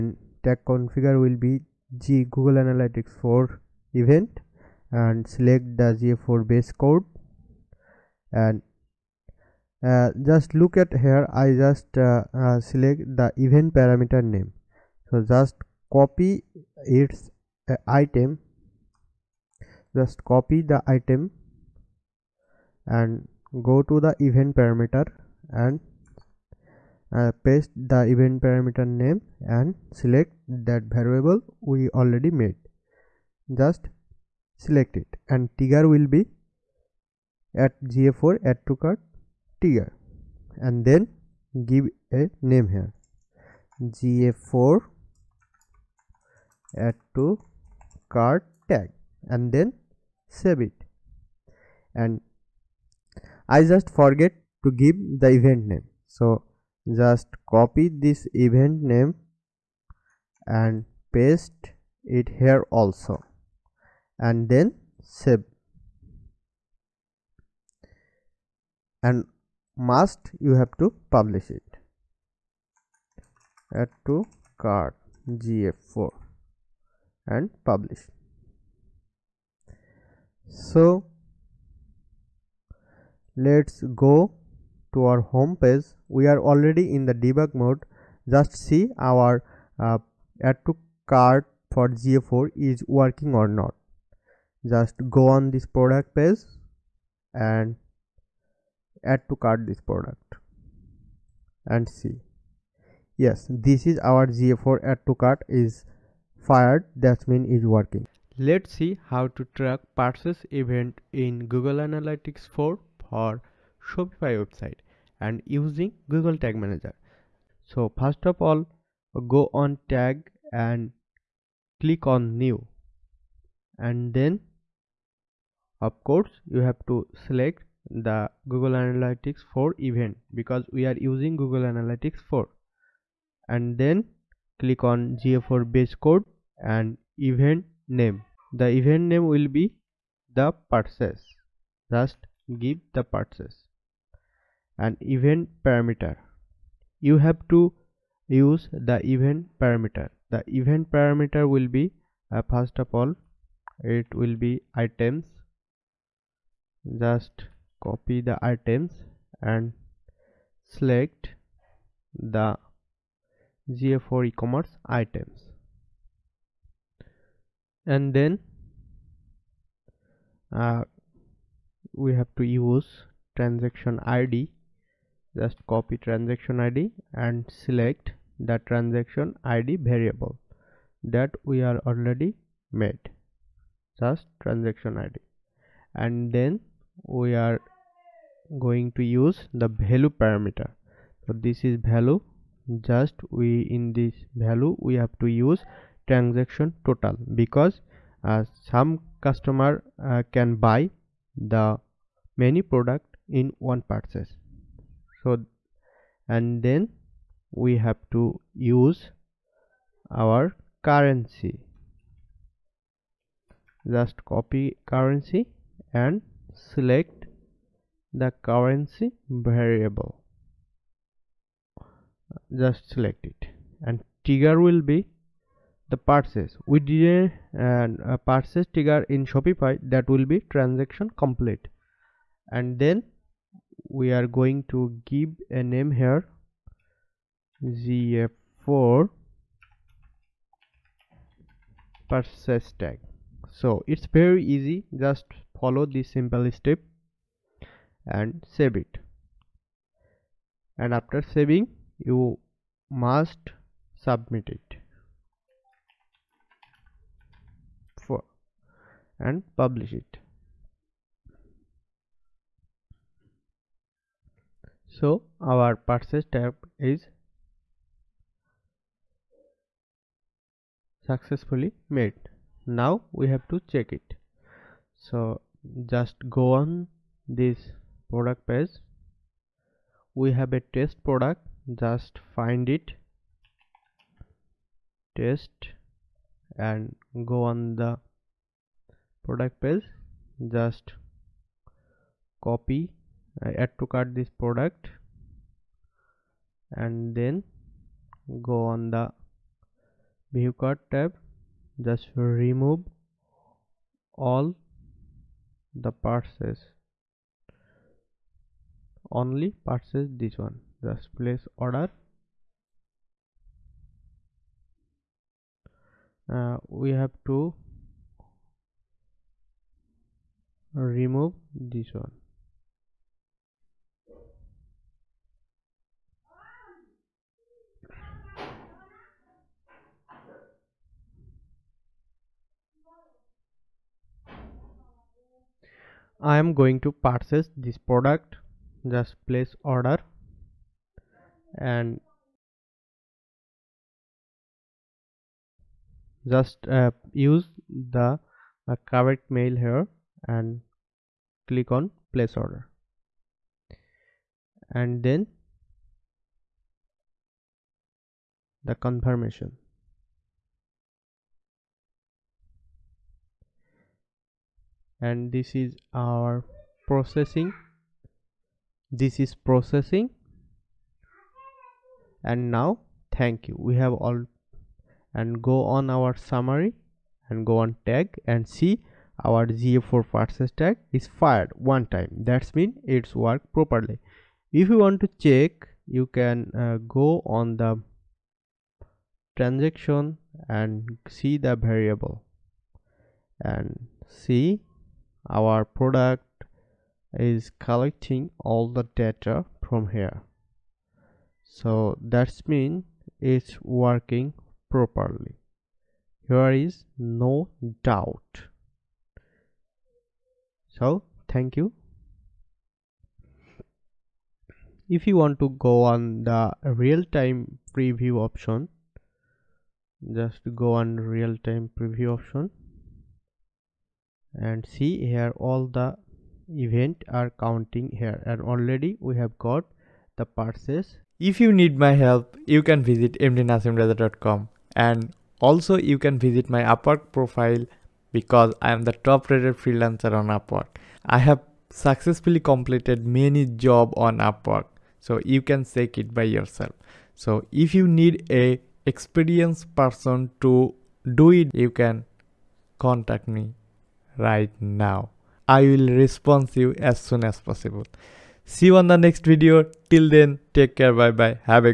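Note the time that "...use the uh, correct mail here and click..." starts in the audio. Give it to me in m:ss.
5:47.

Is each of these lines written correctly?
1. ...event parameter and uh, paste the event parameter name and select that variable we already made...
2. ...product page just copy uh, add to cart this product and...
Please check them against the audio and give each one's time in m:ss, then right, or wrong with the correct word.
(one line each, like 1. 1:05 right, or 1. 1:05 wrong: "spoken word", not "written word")
1. 0:24 right
2. 4:49 right.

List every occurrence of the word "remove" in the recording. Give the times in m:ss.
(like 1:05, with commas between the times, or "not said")
5:02, 5:20.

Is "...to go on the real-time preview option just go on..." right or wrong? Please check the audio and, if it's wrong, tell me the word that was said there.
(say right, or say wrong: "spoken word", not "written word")
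right.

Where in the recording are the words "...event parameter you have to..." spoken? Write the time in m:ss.
2:25.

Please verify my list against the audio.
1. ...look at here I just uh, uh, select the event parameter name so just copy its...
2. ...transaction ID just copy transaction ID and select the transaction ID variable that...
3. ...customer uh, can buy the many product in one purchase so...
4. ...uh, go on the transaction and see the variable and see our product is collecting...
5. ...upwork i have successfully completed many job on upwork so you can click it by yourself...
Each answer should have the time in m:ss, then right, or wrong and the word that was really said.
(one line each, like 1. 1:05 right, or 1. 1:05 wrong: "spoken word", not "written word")
1. 0:10 right
2. 2:53 right
3. 3:19 right
4. 6:26 right
5. 7:20 wrong: "check", not "click".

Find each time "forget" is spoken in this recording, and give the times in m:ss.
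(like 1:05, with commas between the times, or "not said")
0:53.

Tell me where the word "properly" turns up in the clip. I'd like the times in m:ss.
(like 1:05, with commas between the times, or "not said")
6:23, 6:44.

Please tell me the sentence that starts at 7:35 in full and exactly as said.
I will respond you as soon as possible.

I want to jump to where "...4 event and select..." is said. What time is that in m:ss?
0:03.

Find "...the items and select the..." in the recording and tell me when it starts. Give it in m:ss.
2:38.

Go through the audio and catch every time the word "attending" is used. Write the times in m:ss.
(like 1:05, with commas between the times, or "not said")
not said.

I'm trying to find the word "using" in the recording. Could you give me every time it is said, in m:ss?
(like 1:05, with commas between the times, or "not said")
1:55, 2:10.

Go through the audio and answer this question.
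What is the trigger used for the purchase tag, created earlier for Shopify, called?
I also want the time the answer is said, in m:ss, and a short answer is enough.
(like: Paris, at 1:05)
Transaction complete, at 3:50.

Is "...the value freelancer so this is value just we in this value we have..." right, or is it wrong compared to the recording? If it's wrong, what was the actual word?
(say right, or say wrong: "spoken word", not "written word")
wrong: "parameter", not "freelancer".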